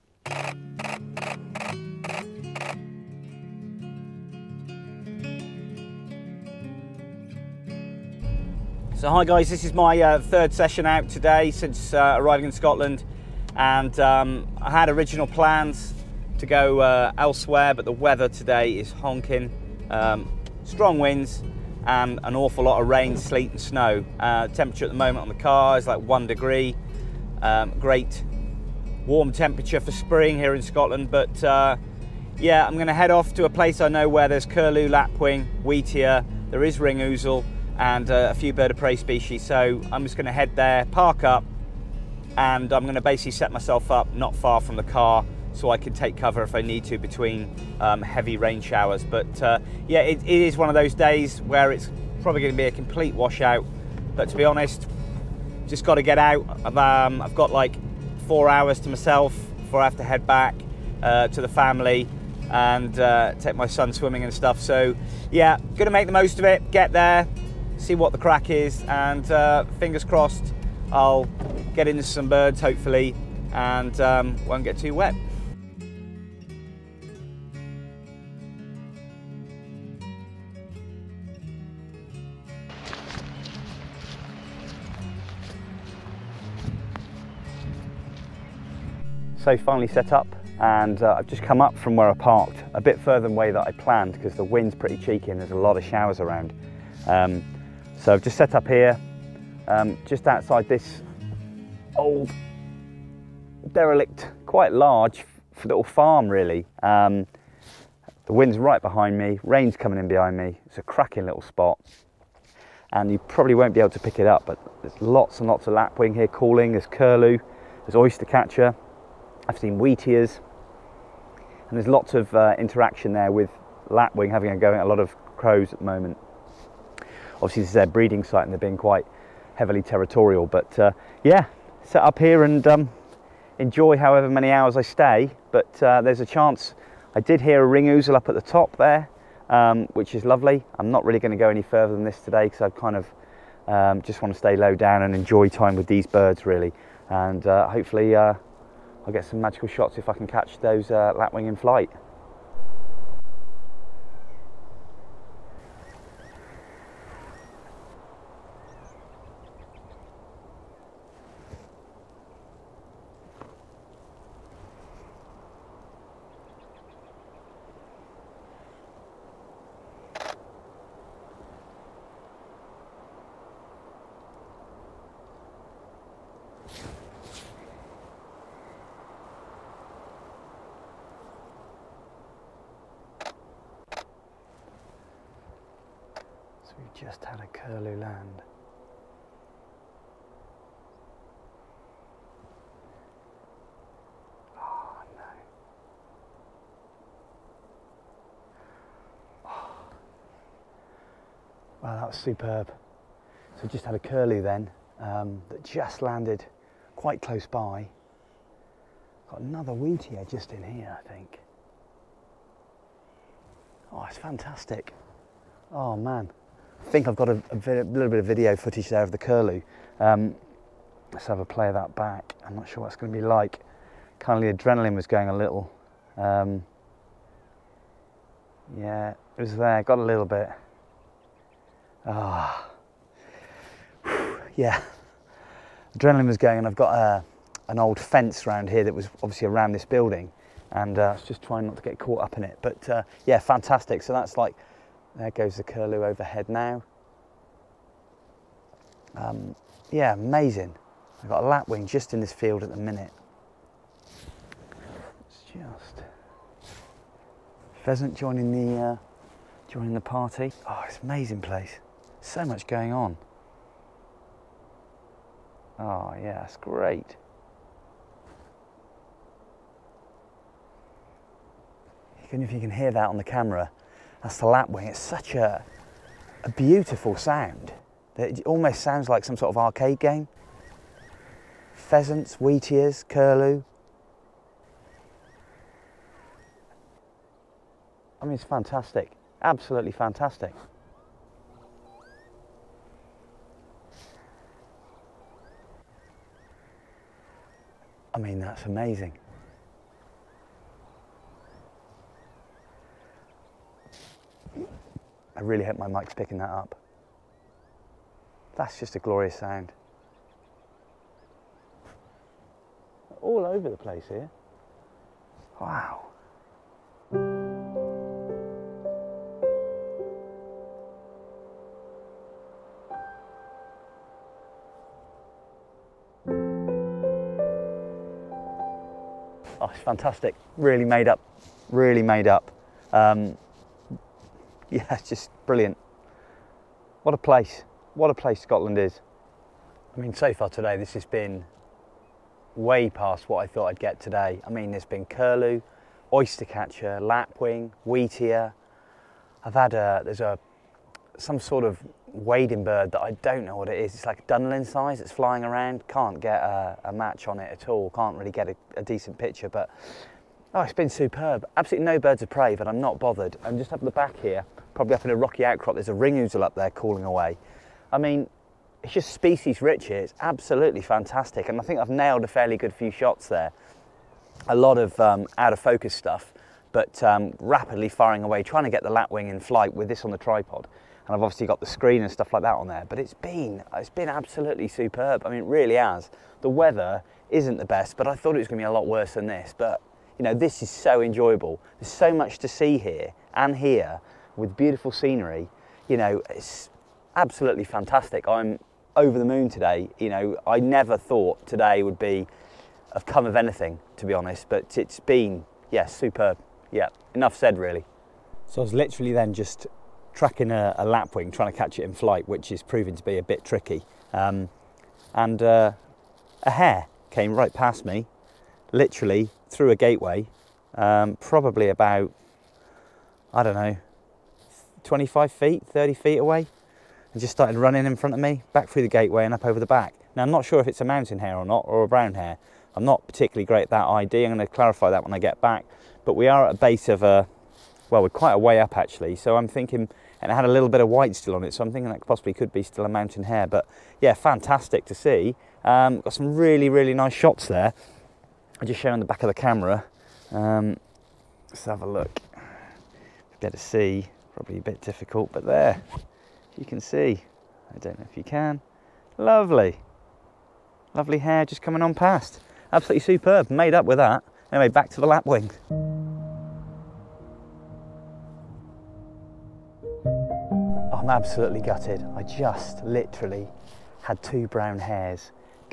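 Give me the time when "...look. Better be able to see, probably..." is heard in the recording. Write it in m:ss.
7:31.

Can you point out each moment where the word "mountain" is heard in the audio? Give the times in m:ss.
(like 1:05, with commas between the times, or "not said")
7:10, 7:22.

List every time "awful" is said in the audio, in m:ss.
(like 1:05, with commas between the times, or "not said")
0:22.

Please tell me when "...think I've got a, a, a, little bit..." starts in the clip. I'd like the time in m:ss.
3:36.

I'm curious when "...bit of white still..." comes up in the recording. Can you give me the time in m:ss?
7:20.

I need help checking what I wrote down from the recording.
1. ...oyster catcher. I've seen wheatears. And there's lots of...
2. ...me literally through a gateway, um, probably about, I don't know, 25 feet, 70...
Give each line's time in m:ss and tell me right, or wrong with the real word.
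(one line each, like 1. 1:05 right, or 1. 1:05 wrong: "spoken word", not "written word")
1. 1:57 right
2. 6:57 wrong: "30", not "70".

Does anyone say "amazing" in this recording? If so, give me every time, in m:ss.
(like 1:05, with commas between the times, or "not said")
4:10, 4:21, 4:58.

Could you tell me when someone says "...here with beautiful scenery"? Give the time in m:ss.
6:33.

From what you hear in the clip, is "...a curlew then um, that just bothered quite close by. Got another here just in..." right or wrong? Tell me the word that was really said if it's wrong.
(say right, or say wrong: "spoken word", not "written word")
wrong: "landed", not "bothered".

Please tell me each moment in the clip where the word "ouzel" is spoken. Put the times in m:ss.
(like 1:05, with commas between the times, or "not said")
2:17, 6:06.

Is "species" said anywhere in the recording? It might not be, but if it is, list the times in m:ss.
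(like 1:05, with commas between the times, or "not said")
0:38, 6:09.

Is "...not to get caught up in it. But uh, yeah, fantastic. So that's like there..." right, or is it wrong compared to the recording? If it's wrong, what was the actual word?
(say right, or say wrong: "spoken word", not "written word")
right.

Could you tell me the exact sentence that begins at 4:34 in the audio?
It's such a, a beautiful sound.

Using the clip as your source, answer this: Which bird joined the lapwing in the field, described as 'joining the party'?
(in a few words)
Pheasant.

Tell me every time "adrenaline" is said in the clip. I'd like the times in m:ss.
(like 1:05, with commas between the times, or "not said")
3:44, 3:55.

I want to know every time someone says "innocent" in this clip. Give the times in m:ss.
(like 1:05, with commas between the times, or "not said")
not said.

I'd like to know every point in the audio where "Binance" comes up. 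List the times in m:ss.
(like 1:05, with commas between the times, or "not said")
not said.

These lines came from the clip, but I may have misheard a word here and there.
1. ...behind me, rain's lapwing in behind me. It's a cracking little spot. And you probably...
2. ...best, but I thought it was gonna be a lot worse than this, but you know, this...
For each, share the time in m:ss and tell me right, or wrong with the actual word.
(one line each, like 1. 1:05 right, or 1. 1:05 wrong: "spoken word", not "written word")
1. 1:48 wrong: "coming", not "lapwing"
2. 6:27 right.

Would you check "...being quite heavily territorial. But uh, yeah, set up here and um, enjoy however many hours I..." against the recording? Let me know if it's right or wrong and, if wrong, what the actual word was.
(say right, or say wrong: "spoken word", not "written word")
right.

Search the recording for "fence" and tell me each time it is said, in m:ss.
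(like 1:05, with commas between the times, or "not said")
3:57.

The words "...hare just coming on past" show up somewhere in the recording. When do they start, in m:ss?
7:41.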